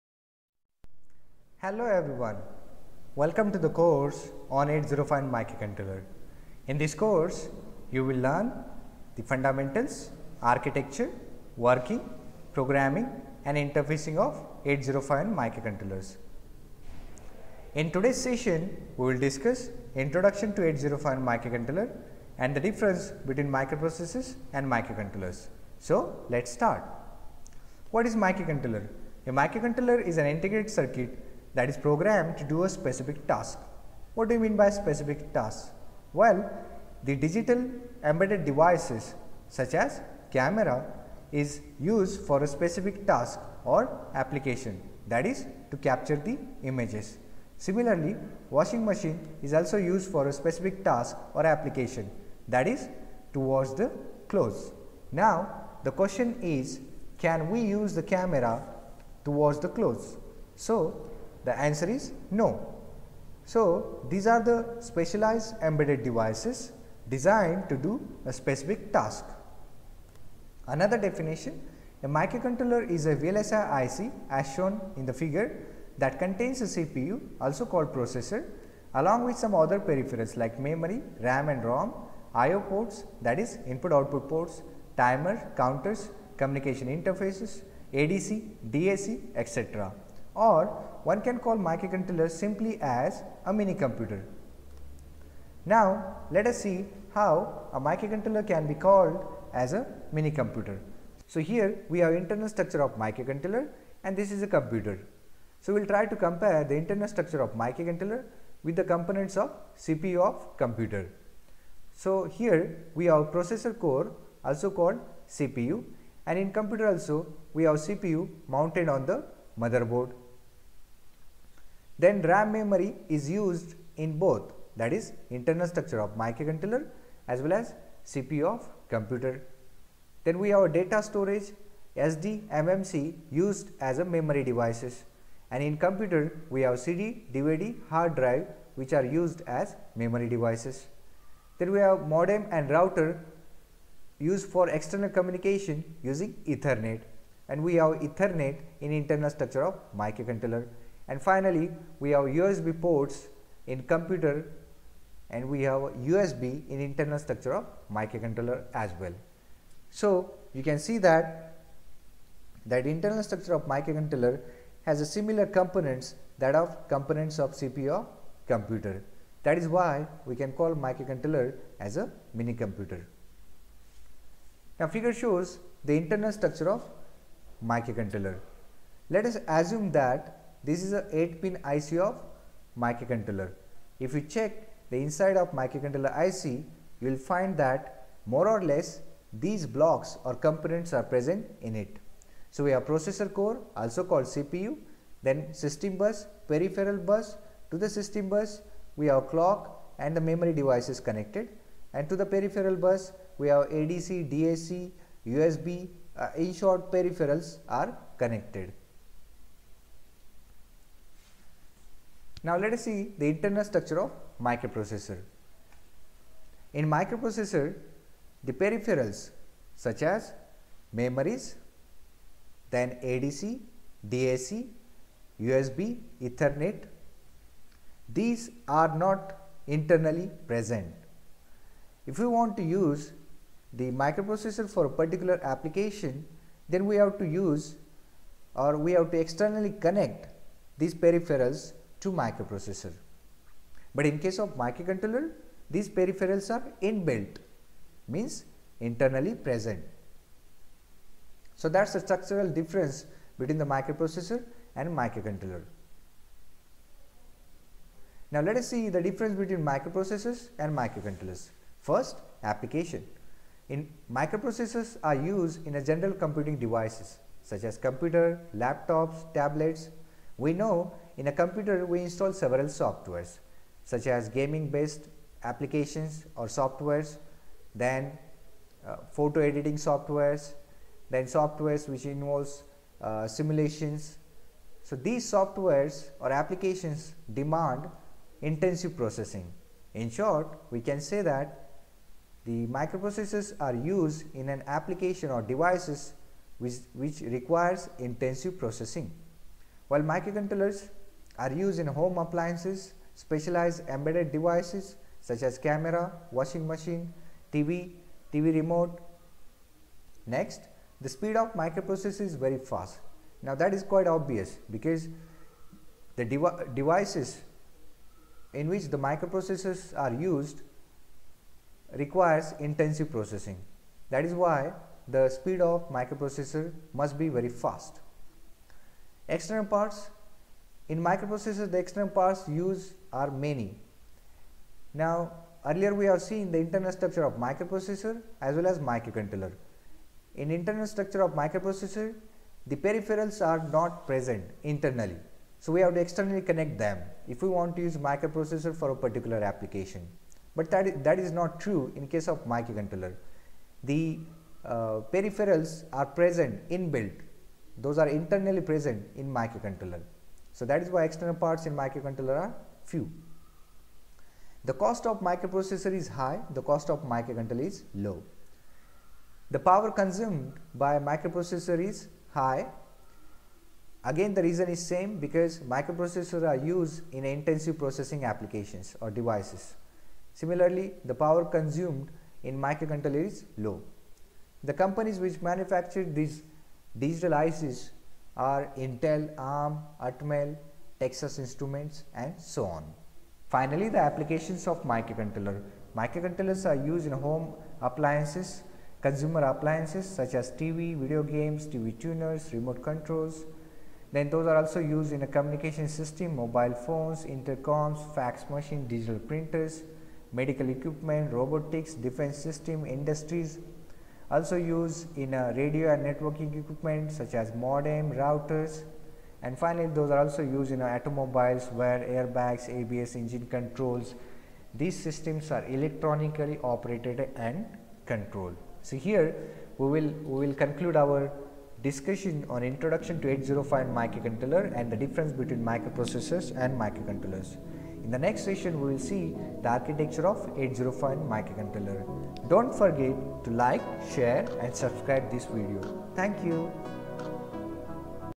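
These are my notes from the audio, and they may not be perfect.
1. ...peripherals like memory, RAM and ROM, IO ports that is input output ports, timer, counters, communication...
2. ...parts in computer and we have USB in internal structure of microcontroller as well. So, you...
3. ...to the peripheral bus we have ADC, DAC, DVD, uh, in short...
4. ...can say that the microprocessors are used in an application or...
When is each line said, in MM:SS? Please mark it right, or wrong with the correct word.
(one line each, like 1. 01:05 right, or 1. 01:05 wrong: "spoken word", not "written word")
1. 01:19 right
2. 02:32 wrong: "ports", not "parts"
3. 03:22 wrong: "USB", not "DVD"
4. 04:50 right.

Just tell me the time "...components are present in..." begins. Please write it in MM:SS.
03:10.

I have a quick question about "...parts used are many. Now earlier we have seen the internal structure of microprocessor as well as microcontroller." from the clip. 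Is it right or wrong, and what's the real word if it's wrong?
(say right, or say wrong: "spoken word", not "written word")
right.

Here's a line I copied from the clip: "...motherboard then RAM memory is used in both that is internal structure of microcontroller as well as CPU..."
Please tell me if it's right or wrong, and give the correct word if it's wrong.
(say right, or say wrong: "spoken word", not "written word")
right.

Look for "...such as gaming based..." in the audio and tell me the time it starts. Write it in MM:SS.
04:33.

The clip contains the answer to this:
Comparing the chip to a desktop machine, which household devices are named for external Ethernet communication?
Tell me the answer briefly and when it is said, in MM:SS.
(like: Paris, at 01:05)
modem and router, at 02:22.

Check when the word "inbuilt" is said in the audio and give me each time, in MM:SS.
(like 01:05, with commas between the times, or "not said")
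04:06, 05:56.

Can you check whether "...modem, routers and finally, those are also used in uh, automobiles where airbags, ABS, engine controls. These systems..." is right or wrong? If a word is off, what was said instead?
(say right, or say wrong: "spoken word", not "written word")
right.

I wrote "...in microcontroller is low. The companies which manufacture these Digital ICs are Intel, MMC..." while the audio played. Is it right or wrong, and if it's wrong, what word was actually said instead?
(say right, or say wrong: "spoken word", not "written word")
wrong: "ARM", not "MMC".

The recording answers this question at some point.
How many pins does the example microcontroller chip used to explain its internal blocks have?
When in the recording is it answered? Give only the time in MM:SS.
03:01.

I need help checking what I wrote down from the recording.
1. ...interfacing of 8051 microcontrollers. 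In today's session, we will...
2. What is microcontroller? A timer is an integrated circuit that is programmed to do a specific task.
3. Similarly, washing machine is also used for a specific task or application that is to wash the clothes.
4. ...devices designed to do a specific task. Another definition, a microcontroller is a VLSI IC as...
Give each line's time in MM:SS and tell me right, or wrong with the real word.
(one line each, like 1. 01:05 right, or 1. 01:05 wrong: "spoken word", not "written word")
1. 00:13 right
2. 00:27 wrong: "microcontroller", not "timer"
3. 00:47 right
4. 01:06 right.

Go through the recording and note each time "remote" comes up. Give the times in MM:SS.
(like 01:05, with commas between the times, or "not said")
05:08, 06:42.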